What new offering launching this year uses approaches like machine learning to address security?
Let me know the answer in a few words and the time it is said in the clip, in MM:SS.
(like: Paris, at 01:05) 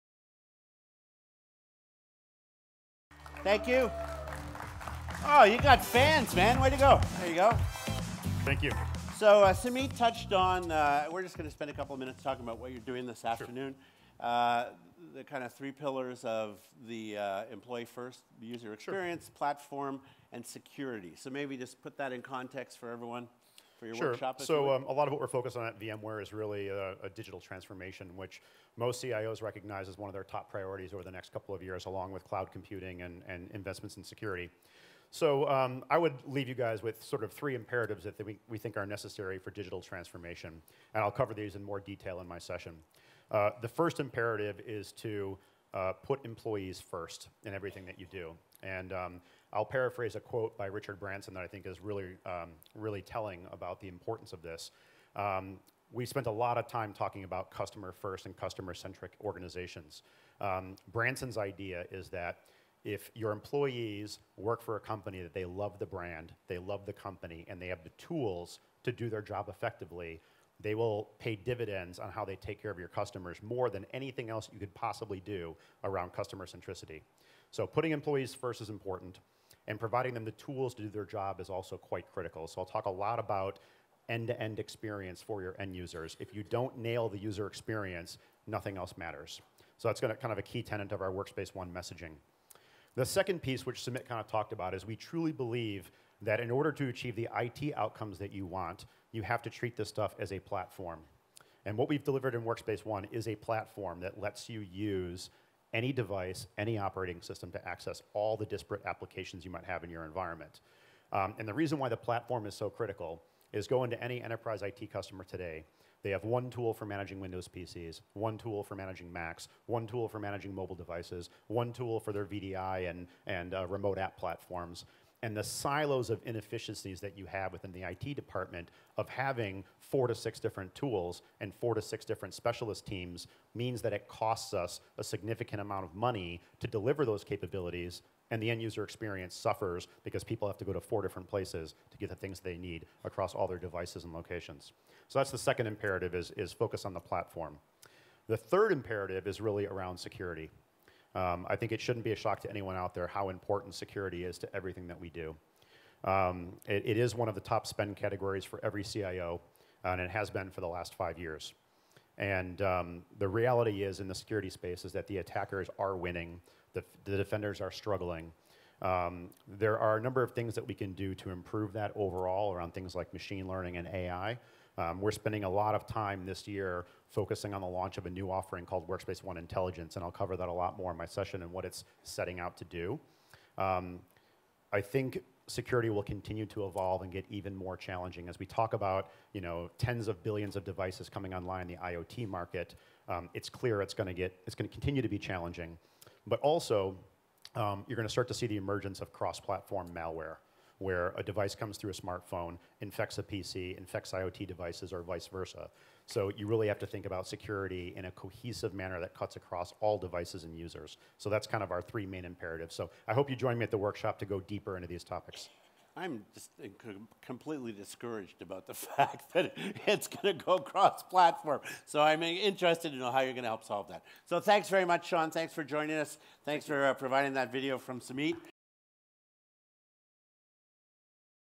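Workspace ONE Intelligence, at 02:58.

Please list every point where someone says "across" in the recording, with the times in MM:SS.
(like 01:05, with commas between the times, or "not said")
02:23, 03:29.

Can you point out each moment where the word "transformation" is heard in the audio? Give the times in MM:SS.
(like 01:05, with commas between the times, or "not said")
00:27, 00:39.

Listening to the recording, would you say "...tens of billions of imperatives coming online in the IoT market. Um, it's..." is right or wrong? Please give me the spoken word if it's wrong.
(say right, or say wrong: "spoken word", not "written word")
wrong: "devices", not "imperatives".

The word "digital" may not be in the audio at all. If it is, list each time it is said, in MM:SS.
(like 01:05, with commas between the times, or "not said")
00:27, 00:39.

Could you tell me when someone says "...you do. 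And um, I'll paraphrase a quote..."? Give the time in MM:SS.
00:47.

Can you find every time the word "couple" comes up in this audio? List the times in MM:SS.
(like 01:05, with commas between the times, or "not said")
00:11, 00:31.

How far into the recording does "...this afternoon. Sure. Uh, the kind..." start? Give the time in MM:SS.
00:13.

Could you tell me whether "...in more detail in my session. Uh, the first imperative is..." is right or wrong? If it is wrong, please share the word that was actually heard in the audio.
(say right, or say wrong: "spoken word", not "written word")
right.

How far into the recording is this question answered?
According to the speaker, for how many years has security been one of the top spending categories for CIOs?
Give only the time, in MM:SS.
02:40.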